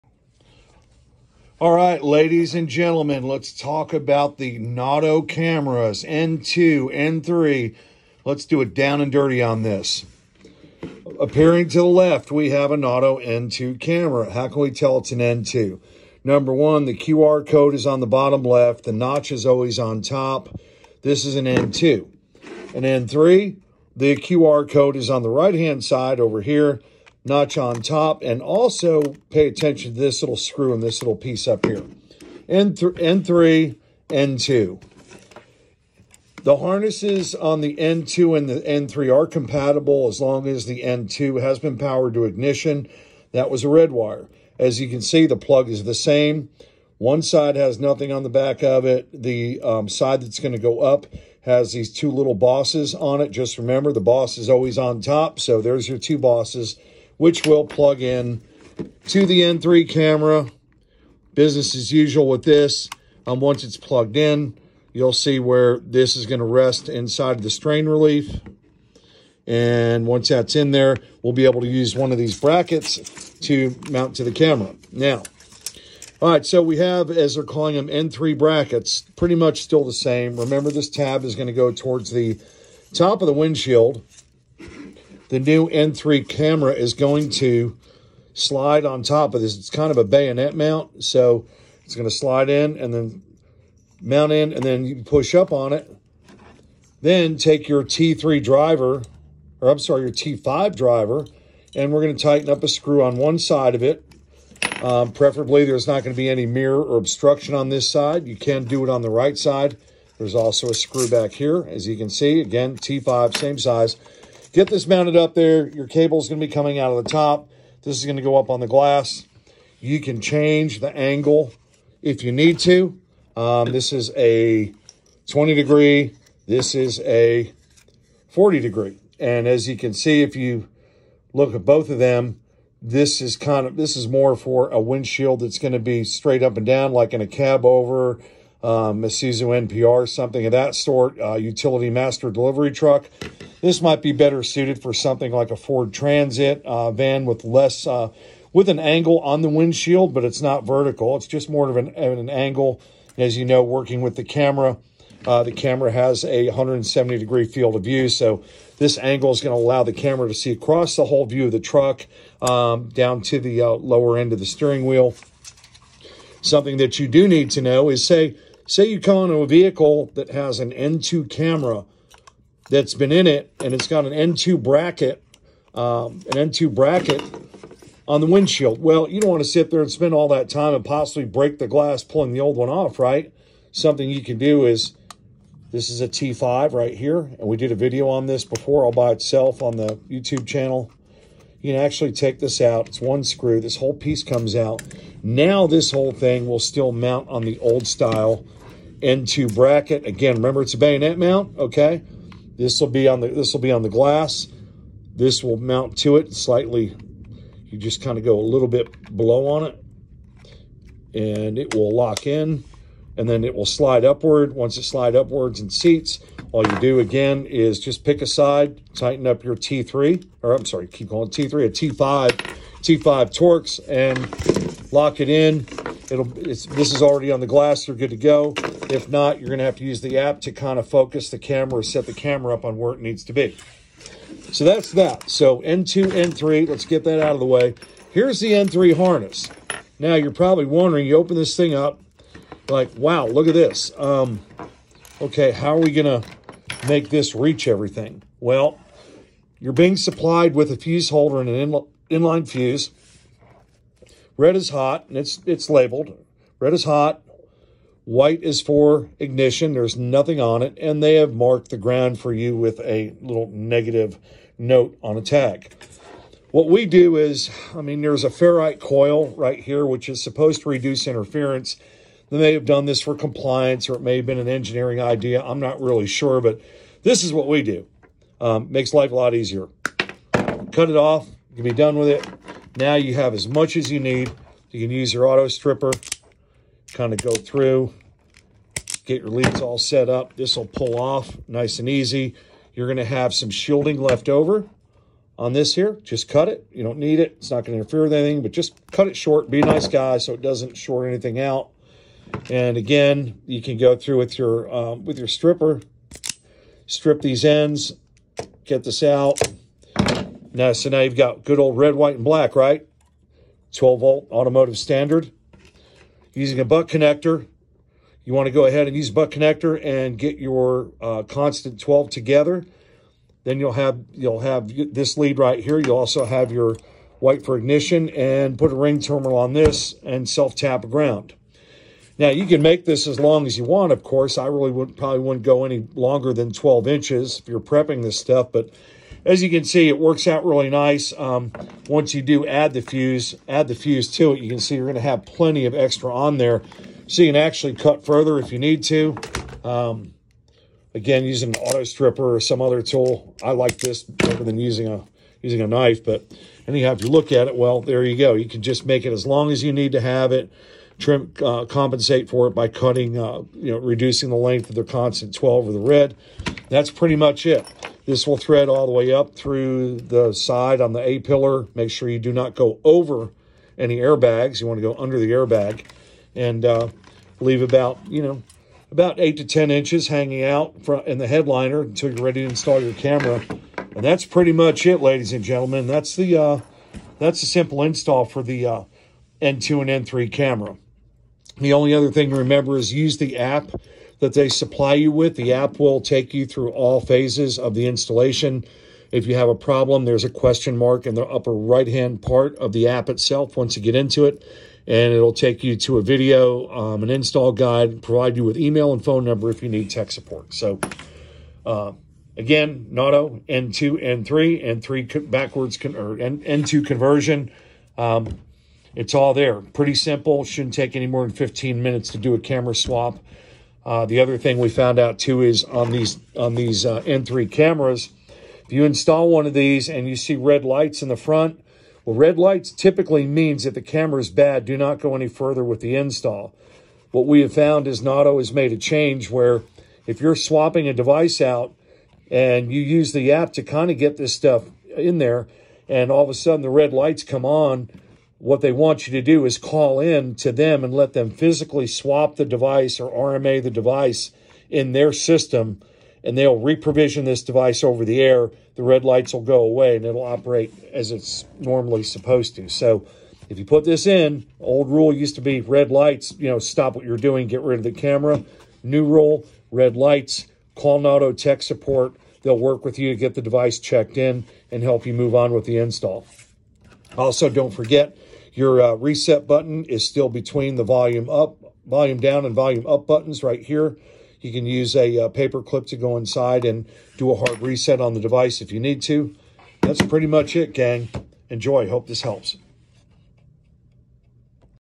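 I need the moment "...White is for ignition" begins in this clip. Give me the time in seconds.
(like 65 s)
258 s.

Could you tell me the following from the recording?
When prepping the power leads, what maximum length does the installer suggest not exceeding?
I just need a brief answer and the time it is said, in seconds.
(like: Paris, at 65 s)
12 inches, at 336 s.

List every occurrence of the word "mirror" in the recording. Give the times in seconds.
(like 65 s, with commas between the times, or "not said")
106 s.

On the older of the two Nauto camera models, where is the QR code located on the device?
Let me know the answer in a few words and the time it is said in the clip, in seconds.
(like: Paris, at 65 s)
bottom left, at 18 s.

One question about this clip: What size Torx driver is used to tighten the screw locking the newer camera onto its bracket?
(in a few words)
T5.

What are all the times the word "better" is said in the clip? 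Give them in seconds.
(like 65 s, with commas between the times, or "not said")
144 s, 354 s.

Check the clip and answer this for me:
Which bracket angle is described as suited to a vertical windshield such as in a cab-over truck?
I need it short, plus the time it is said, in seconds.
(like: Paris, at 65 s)
20 degree, at 125 s.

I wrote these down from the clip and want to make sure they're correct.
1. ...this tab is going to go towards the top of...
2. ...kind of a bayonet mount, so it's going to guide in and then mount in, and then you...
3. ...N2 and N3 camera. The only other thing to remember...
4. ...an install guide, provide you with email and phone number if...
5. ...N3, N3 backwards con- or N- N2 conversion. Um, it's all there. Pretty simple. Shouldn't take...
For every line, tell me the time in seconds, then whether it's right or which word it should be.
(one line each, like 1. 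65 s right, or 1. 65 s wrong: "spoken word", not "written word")
1. 80 s right
2. 89 s wrong: "slide", not "guide"
3. 389 s right
4. 407 s right
5. 414 s right.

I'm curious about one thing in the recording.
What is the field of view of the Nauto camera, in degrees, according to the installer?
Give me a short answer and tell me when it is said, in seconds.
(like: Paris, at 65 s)
170 degrees, at 156 s.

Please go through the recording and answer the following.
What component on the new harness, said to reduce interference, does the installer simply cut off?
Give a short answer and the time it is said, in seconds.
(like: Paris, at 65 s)
ferrite coil, at 268 s.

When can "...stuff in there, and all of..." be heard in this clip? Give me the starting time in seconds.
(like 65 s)
444 s.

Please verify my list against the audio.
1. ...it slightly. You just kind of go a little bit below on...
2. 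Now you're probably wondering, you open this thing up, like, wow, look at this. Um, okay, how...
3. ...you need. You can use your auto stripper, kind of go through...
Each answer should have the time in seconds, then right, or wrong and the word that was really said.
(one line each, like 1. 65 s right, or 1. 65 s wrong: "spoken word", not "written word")
1. 206 s right
2. 239 s right
3. 283 s right.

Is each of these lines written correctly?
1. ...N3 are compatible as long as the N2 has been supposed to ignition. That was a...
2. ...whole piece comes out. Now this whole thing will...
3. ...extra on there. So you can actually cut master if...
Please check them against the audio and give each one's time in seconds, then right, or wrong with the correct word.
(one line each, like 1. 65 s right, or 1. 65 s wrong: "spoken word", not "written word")
1. 38 s wrong: "powered", not "supposed"
2. 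193 s right
3. 345 s wrong: "further", not "master".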